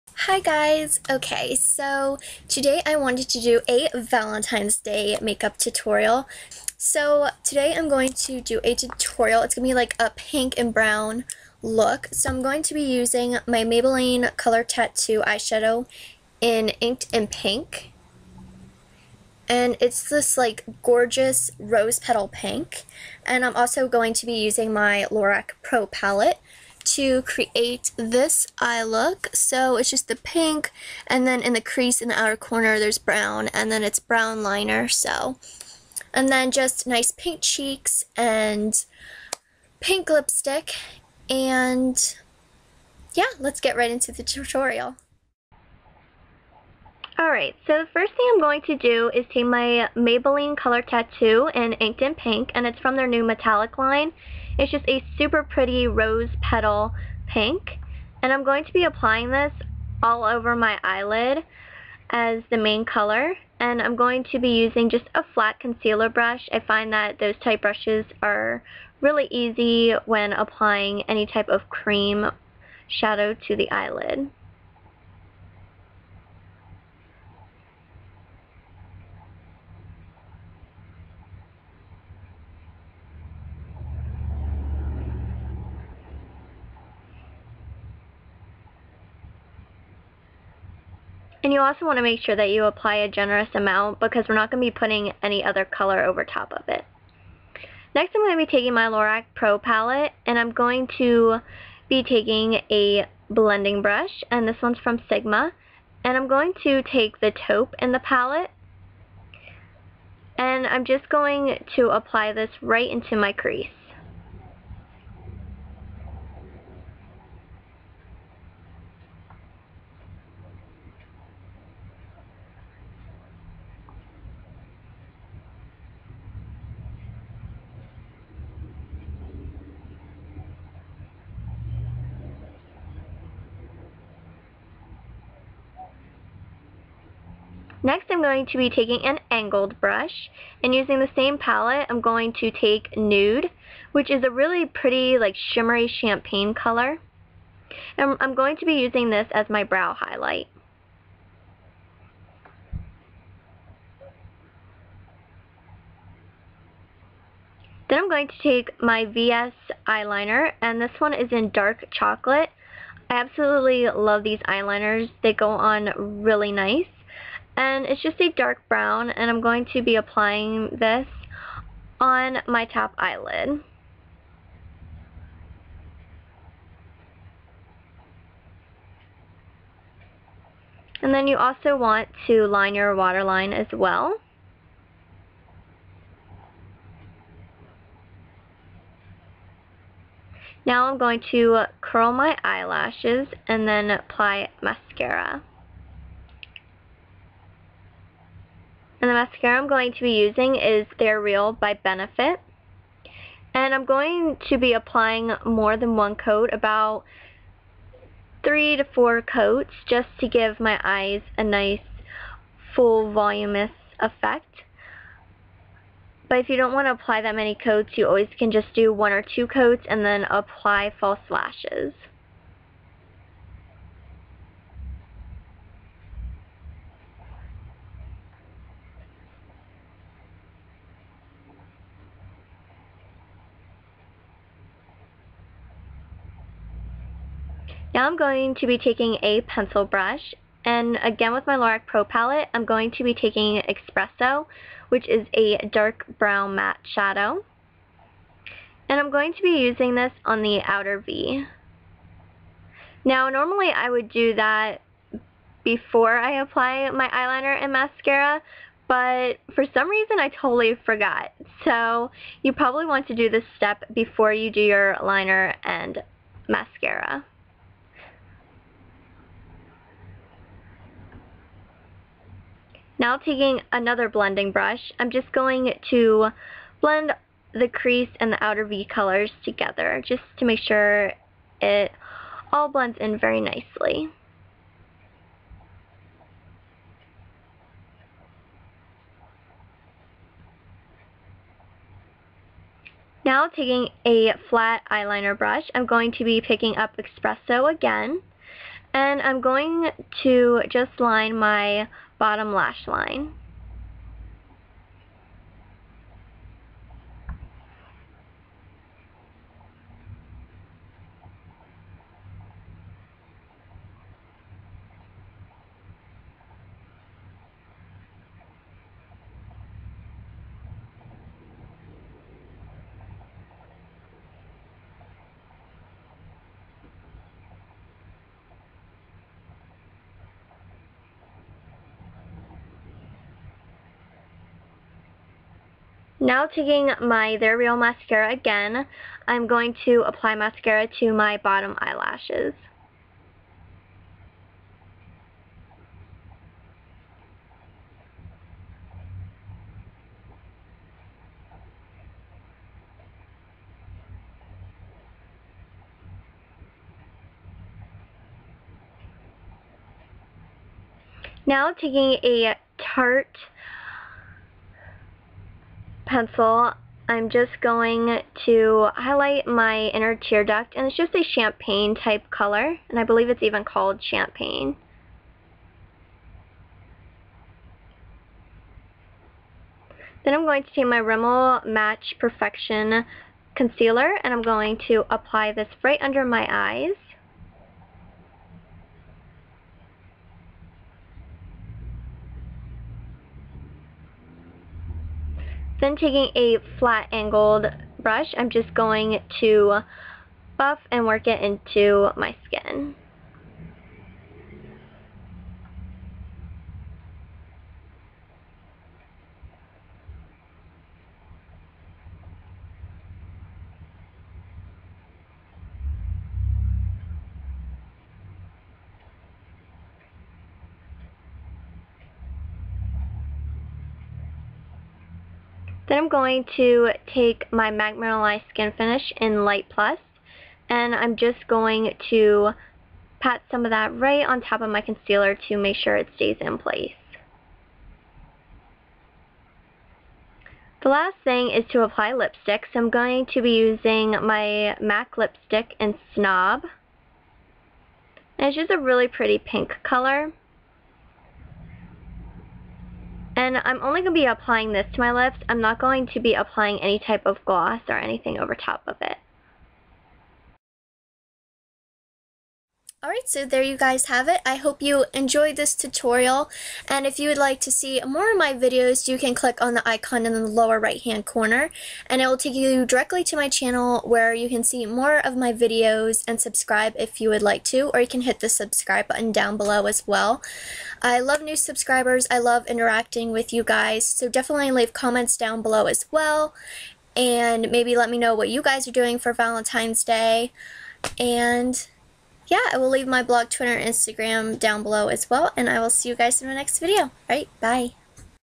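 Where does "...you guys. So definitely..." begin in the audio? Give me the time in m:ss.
8:03.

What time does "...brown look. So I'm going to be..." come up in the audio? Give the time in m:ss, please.
0:10.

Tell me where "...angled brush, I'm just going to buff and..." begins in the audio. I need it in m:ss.
6:37.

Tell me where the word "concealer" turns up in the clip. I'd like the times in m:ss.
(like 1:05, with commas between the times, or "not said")
1:05, 6:23, 7:14.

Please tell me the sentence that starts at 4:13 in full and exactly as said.
Now normally I would do that before I apply my eyeliner and mascara but for some reason I totally forgot.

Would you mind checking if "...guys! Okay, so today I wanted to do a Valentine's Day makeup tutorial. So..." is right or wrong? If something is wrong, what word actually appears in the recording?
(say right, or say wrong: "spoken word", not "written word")
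right.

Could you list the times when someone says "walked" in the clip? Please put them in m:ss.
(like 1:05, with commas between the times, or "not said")
not said.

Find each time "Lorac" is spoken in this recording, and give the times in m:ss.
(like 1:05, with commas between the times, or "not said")
0:25, 1:38, 4:01.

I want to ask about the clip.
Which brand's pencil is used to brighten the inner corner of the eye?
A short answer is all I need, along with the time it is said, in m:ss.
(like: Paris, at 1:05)
Tarte, at 6:02.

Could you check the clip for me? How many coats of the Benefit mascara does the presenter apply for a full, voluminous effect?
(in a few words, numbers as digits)
3 to 4.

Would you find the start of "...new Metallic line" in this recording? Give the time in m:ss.
0:53.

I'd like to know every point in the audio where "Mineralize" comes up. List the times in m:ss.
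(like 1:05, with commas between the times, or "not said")
7:07.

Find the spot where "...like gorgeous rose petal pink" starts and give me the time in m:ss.
0:20.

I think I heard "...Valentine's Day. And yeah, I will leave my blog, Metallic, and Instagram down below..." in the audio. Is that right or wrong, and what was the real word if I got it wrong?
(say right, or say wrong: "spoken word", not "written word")
wrong: "Twitter", not "Metallic".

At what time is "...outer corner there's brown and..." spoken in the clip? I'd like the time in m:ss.
0:32.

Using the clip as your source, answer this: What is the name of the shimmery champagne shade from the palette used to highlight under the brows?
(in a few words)
Nude.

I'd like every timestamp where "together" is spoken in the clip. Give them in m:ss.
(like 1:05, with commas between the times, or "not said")
4:39.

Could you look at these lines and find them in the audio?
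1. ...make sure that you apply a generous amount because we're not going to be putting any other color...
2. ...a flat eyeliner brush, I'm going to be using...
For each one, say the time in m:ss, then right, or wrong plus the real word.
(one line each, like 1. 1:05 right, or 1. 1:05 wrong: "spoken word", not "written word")
1. 1:32 right
2. 4:54 wrong: "picking", not "using".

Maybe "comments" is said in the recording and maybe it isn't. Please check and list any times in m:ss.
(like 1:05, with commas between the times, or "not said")
8:04.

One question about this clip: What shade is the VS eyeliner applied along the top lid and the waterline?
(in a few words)
dark chocolate.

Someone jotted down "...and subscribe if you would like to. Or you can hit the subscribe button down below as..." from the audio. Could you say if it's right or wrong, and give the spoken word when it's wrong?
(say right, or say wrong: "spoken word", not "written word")
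right.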